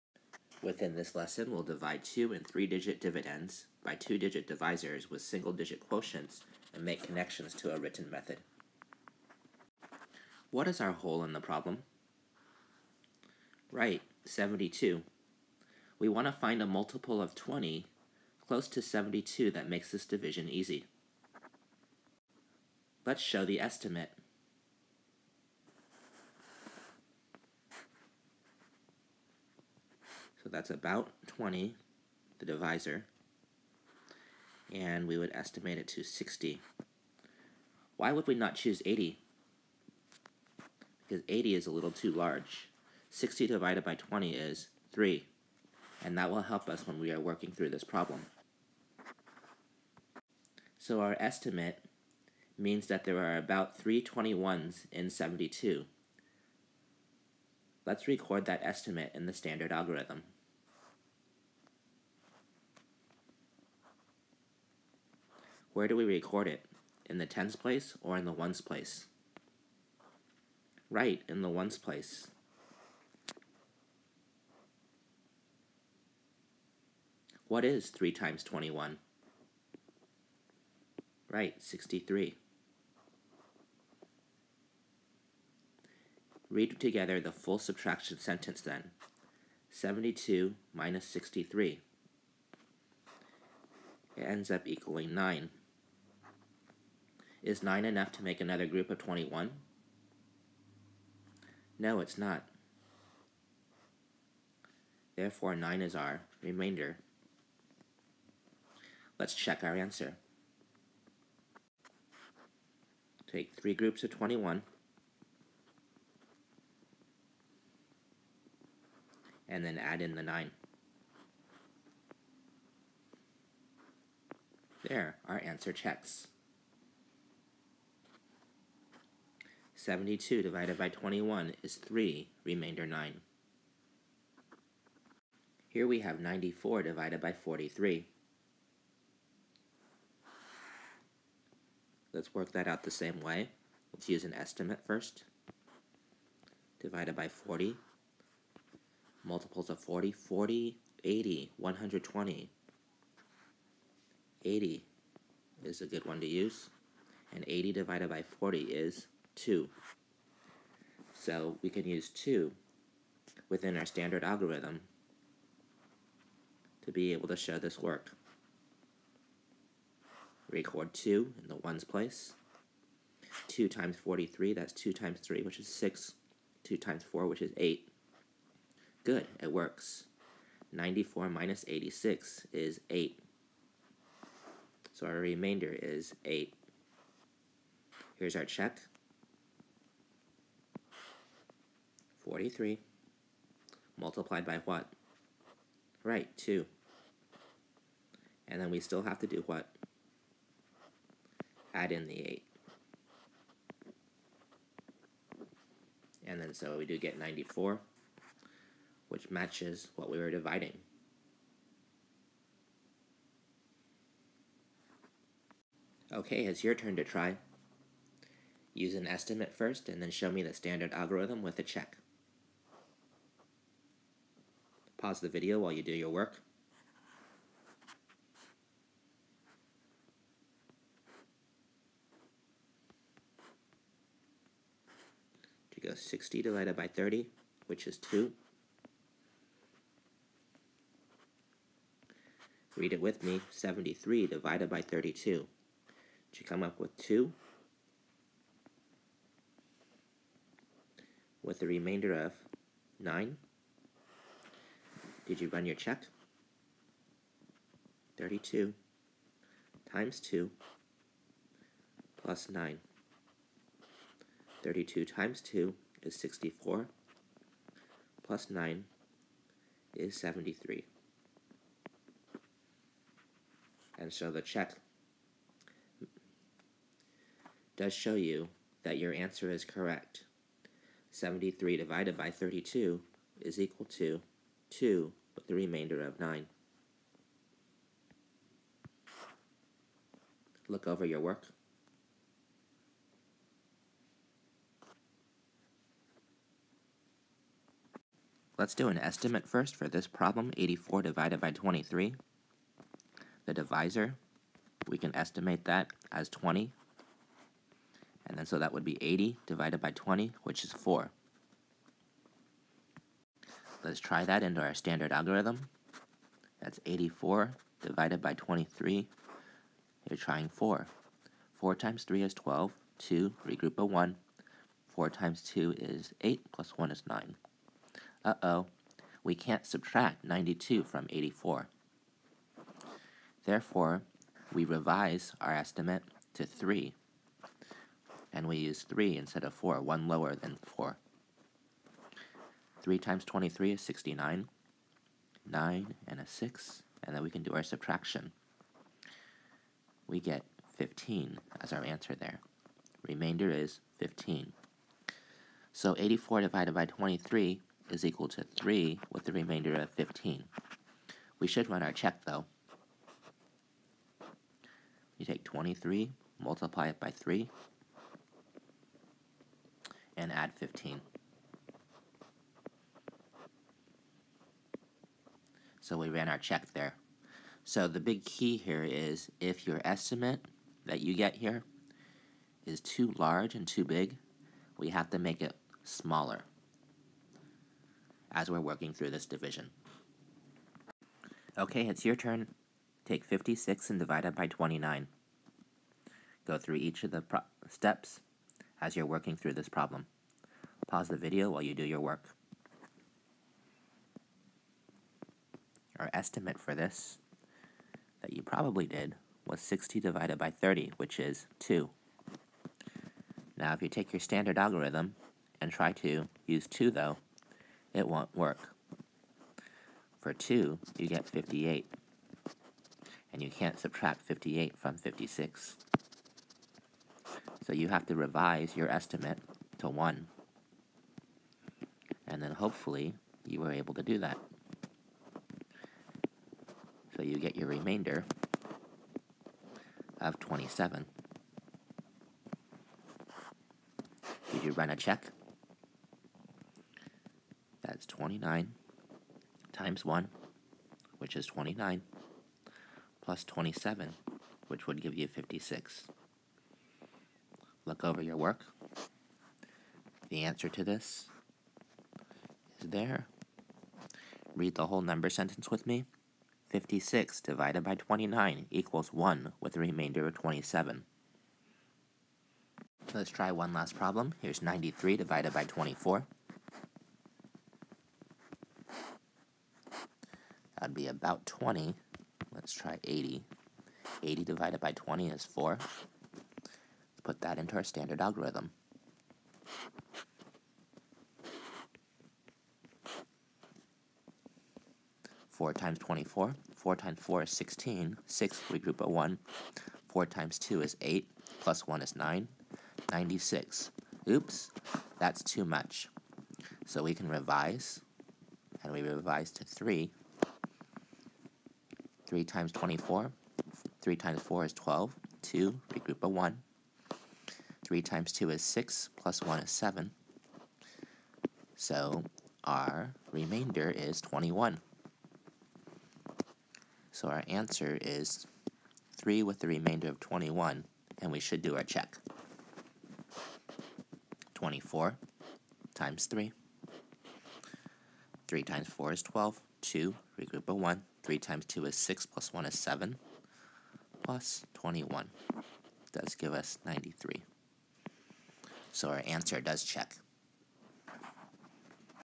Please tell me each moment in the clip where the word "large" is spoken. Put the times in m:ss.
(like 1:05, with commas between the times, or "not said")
0:42, 6:23.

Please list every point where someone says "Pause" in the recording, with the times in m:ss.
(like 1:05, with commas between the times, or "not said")
3:44, 6:40.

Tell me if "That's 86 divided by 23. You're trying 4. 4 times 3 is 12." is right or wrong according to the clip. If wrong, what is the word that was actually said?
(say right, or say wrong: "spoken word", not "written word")
wrong: "84", not "86".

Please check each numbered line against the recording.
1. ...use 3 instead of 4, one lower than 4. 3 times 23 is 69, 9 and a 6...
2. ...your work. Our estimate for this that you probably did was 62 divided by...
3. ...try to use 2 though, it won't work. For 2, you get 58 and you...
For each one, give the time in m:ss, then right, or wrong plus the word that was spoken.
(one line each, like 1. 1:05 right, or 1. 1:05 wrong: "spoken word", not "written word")
1. 5:38 right
2. 6:41 wrong: "60", not "62"
3. 6:55 right.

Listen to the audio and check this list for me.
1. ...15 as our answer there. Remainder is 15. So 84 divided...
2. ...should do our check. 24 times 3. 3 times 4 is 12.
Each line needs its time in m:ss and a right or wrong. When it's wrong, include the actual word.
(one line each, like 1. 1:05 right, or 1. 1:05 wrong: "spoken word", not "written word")
1. 5:50 right
2. 8:51 right.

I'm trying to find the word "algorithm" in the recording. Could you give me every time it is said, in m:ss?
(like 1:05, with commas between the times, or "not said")
0:59, 2:44, 3:40, 5:15, 6:54, 8:08.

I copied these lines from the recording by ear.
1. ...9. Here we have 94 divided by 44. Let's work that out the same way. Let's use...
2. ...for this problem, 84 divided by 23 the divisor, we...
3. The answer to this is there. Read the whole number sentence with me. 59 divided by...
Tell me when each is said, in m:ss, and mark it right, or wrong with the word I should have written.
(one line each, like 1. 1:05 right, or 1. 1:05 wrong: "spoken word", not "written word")
1. 2:12 wrong: "43", not "44"
2. 4:59 right
3. 7:40 wrong: "56", not "59".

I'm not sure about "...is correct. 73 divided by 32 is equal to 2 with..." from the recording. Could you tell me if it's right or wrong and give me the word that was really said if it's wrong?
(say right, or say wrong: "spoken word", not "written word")
right.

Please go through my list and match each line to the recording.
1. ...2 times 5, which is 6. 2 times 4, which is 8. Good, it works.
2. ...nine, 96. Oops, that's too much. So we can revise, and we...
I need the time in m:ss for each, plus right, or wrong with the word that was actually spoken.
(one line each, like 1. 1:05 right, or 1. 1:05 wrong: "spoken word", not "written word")
1. 2:54 wrong: "3", not "5"
2. 8:22 right.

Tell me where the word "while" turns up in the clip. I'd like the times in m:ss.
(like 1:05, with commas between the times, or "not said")
3:45, 6:41.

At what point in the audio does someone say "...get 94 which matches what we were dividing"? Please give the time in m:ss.
3:26.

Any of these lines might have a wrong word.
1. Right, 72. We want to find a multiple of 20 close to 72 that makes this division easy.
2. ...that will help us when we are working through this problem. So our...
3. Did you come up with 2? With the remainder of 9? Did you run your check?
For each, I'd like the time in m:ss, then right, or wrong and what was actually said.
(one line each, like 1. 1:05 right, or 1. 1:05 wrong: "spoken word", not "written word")
1. 0:13 right
2. 0:46 right
3. 4:06 right.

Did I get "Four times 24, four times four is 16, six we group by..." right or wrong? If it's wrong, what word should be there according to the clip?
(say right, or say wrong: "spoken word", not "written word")
right.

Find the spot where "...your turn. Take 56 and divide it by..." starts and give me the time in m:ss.
6:32.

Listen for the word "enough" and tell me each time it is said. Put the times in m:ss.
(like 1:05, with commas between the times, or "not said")
1:37.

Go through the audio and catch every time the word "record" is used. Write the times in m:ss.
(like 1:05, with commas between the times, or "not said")
0:58, 1:06, 2:50.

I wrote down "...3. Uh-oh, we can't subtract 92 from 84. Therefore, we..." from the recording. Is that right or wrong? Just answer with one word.
wrong.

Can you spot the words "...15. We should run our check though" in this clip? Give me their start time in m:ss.
5:59.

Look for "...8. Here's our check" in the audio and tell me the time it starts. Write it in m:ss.
3:06.